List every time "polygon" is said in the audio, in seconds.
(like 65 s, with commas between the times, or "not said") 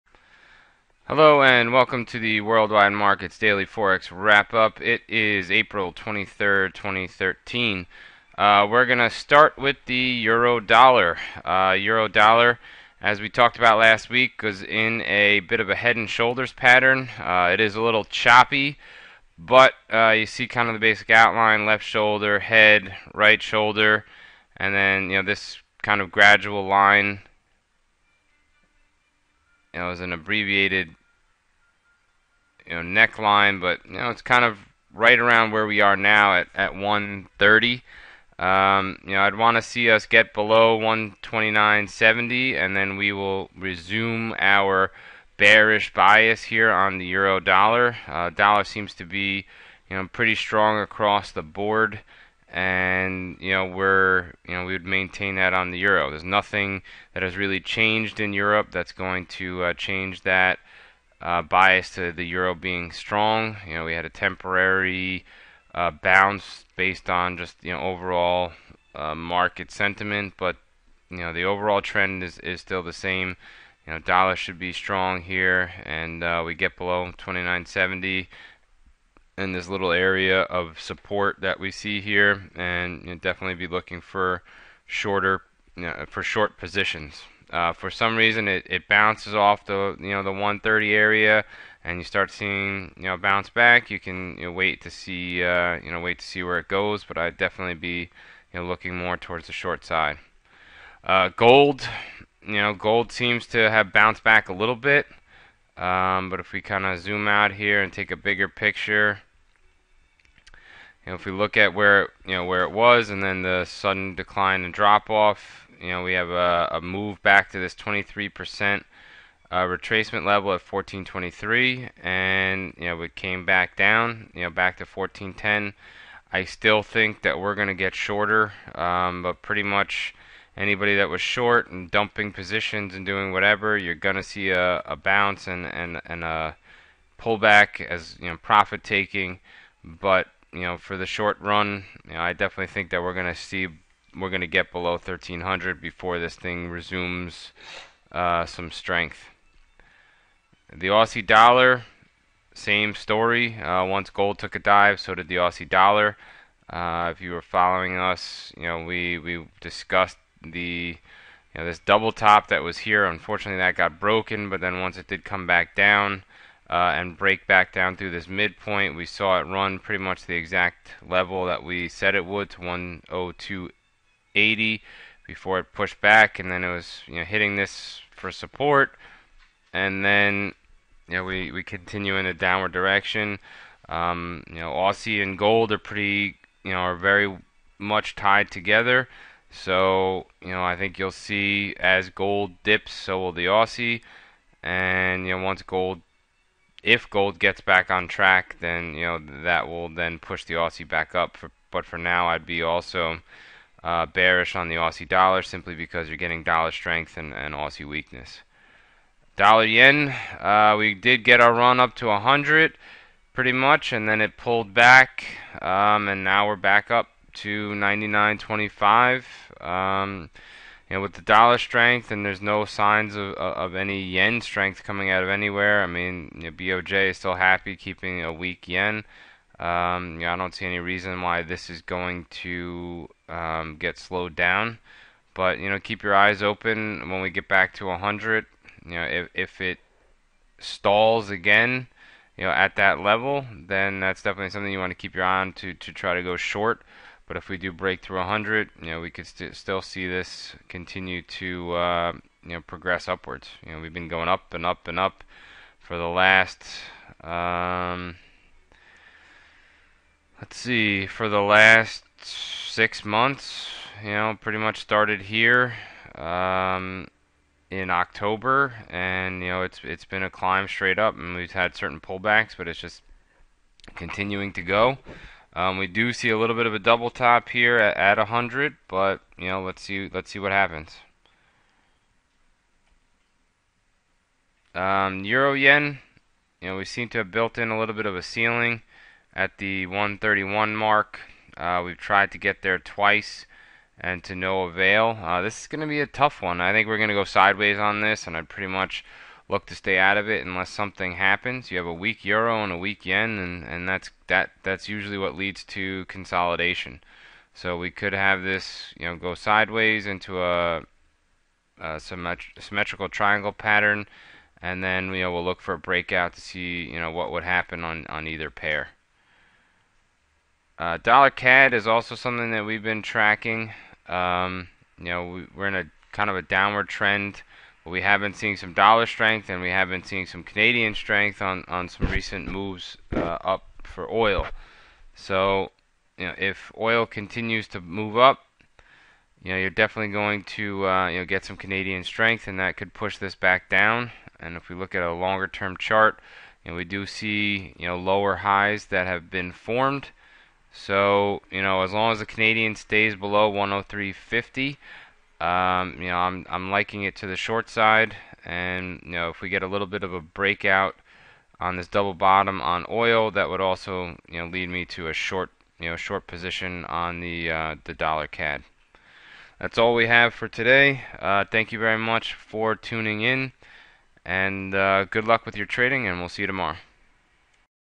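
not said.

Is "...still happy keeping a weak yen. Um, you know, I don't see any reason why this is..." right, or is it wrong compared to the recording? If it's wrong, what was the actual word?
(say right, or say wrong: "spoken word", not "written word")
right.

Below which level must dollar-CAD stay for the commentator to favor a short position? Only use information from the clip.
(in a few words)
103.50.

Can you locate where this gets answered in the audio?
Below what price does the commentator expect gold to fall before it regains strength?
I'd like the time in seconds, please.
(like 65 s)
144 s.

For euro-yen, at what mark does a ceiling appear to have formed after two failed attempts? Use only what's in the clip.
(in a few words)
131.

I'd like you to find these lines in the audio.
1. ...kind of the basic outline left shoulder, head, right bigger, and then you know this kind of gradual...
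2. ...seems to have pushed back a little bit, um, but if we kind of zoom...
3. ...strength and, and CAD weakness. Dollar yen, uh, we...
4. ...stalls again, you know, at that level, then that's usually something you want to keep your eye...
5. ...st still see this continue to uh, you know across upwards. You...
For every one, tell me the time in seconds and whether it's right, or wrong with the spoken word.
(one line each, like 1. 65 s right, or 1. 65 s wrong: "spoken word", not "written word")
1. 20 s wrong: "shoulder", not "bigger"
2. 103 s wrong: "bounced", not "pushed"
3. 206 s wrong: "Aussie", not "CAD"
4. 240 s wrong: "definitely", not "usually"
5. 249 s wrong: "progress", not "across".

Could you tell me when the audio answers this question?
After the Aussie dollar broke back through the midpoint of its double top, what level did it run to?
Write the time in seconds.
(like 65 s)
172 s.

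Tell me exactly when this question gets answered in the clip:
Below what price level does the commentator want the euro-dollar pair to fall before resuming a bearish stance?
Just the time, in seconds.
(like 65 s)
40 s.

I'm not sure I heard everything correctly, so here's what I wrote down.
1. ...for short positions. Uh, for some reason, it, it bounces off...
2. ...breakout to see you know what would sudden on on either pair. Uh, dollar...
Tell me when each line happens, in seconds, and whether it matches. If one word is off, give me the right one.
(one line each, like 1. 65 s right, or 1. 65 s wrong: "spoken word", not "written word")
1. 86 s right
2. 315 s wrong: "happen", not "sudden".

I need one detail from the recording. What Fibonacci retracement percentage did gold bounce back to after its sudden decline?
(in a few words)
23%.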